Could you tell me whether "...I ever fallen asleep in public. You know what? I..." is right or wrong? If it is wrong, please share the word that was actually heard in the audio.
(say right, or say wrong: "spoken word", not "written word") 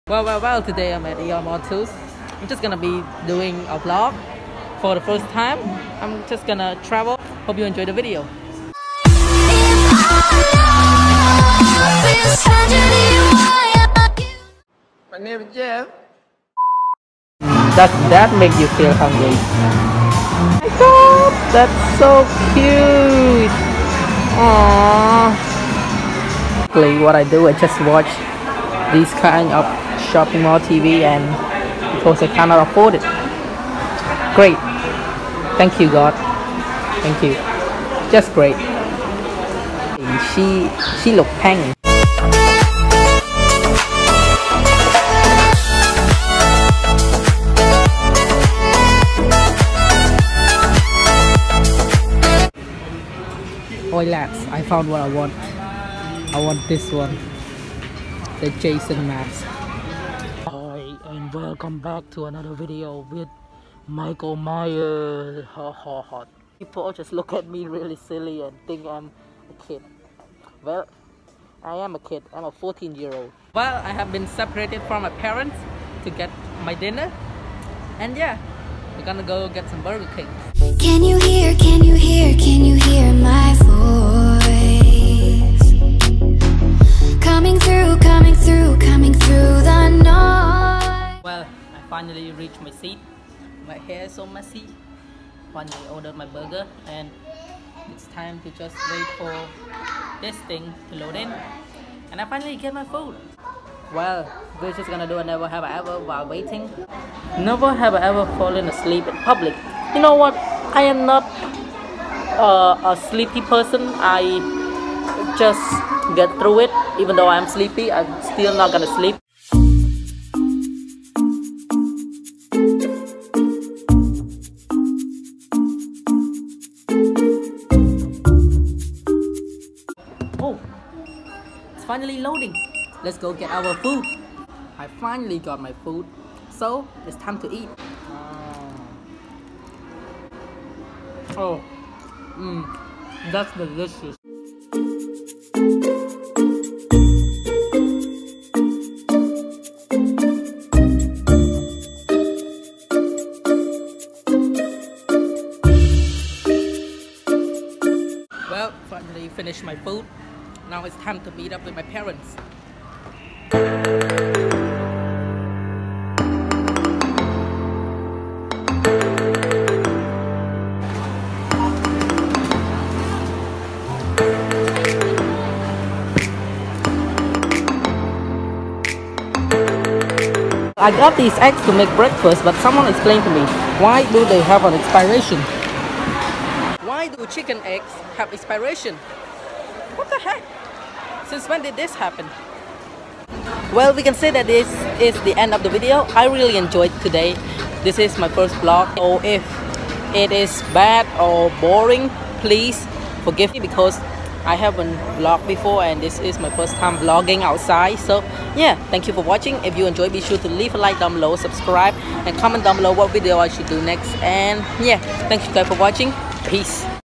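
right.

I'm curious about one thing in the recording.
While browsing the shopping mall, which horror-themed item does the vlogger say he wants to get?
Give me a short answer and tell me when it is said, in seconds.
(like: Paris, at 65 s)
The Jason mask, at 58 s.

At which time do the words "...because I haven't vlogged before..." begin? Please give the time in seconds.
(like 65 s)
203 s.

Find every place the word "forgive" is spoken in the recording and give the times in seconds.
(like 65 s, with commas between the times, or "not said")
203 s.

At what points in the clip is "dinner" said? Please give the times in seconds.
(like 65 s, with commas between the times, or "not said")
76 s.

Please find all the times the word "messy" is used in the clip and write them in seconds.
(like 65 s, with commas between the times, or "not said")
94 s.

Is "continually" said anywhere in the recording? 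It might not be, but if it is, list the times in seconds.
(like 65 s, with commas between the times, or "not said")
not said.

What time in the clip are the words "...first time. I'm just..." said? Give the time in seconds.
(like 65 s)
4 s.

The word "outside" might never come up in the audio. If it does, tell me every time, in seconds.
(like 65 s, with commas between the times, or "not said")
207 s.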